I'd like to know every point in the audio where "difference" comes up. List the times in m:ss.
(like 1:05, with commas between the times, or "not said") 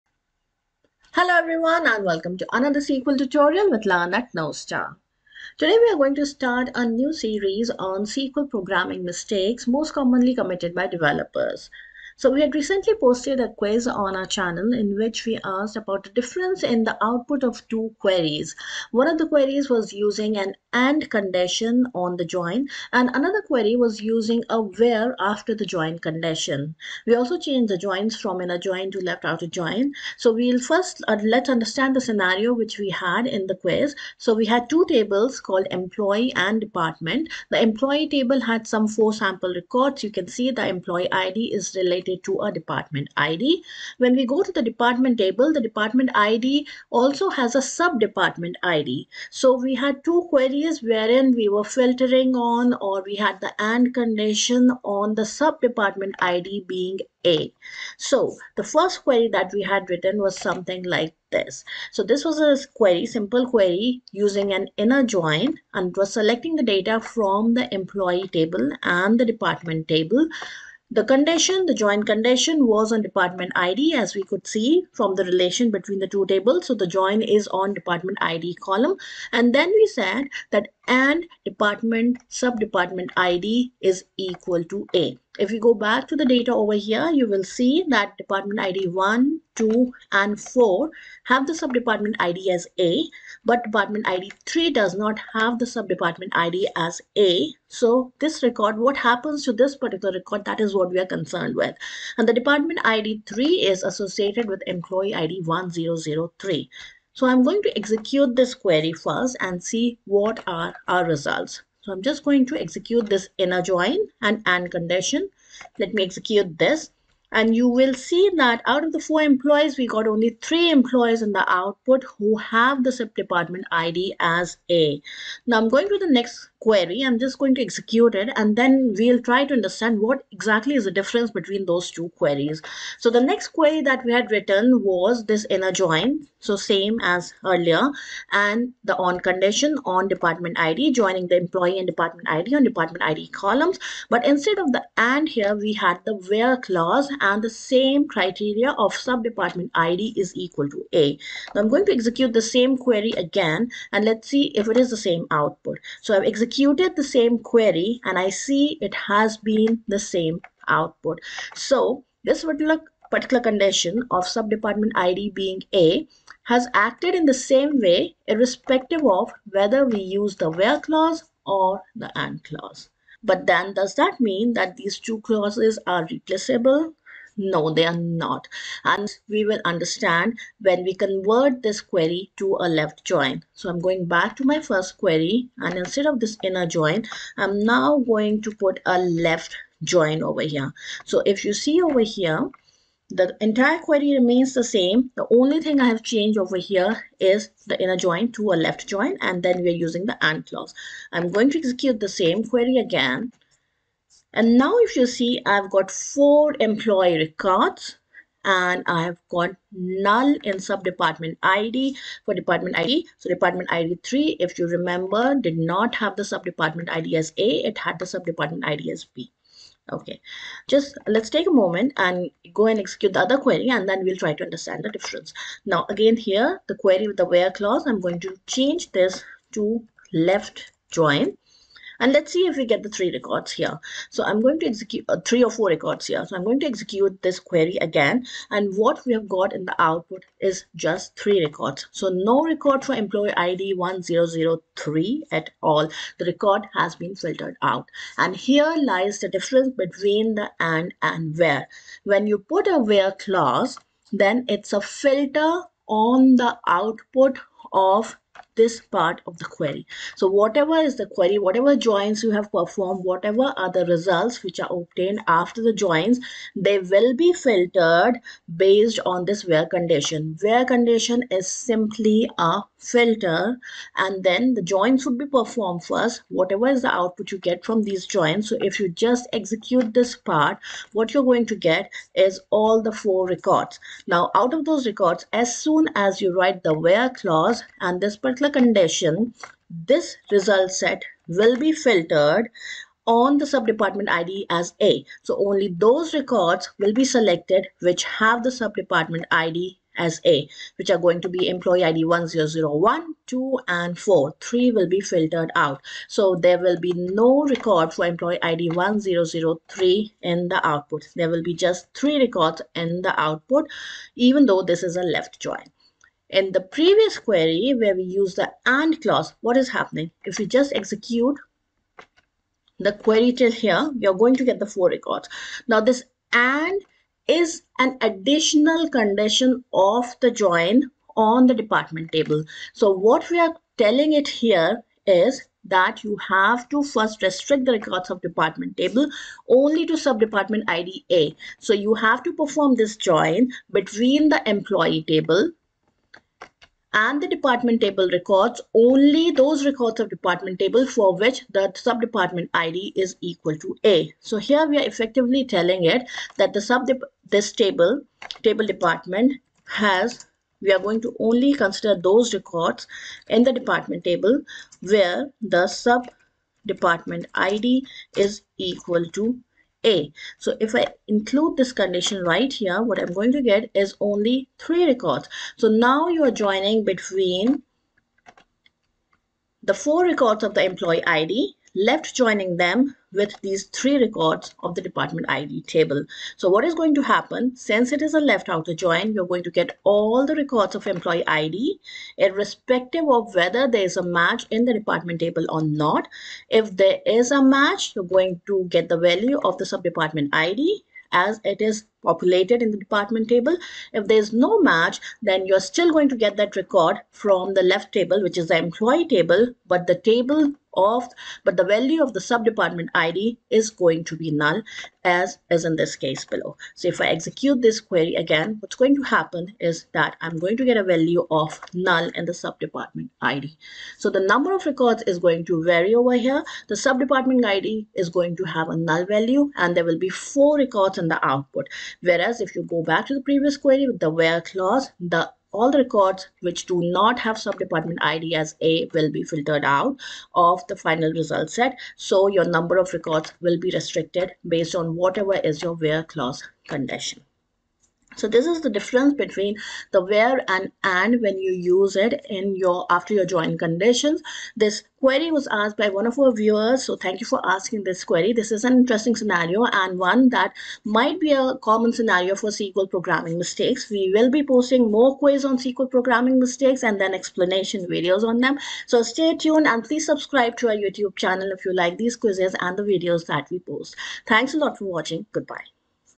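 0:16, 2:10, 3:44, 4:09, 7:28.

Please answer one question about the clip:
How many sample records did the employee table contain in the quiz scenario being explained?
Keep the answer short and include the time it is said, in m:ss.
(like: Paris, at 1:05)
4, at 0:38.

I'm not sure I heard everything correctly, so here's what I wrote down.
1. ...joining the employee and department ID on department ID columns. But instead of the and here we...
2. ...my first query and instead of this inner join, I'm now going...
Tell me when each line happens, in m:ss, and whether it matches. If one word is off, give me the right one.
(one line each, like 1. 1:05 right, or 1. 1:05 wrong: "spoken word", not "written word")
1. 2:20 right
2. 3:04 right.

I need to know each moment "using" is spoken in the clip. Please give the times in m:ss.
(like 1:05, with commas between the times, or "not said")
0:19, 0:24, 1:04, 3:19.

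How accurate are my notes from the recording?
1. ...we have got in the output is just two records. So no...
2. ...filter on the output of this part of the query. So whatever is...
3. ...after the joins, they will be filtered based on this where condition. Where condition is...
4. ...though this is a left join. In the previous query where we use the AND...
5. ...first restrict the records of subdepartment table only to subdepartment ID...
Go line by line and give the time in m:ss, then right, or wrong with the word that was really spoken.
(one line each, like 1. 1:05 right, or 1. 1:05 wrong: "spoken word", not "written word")
1. 3:59 wrong: "three", not "two"
2. 4:14 right
3. 4:25 right
4. 5:14 right
5. 5:36 wrong: "department", not "subdepartment".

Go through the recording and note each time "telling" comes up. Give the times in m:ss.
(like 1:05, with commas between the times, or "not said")
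5:33, 5:55.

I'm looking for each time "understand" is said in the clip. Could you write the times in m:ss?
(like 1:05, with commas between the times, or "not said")
0:31, 2:09, 2:59, 3:44.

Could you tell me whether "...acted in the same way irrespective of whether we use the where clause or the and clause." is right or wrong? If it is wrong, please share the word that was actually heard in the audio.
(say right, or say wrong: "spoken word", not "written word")
right.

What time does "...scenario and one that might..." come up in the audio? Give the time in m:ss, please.
7:39.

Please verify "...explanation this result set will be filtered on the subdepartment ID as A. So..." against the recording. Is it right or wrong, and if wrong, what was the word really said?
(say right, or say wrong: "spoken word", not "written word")
wrong: "condition", not "explanation".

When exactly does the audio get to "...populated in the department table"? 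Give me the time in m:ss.
6:42.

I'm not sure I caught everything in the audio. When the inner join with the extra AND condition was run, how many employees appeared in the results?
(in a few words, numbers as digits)
3.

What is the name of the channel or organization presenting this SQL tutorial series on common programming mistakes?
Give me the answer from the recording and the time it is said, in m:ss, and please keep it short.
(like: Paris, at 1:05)
Learn at Knowstar, at 0:03.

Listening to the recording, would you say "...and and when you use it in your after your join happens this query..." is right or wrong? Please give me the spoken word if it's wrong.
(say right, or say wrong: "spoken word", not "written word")
wrong: "conditions", not "happens".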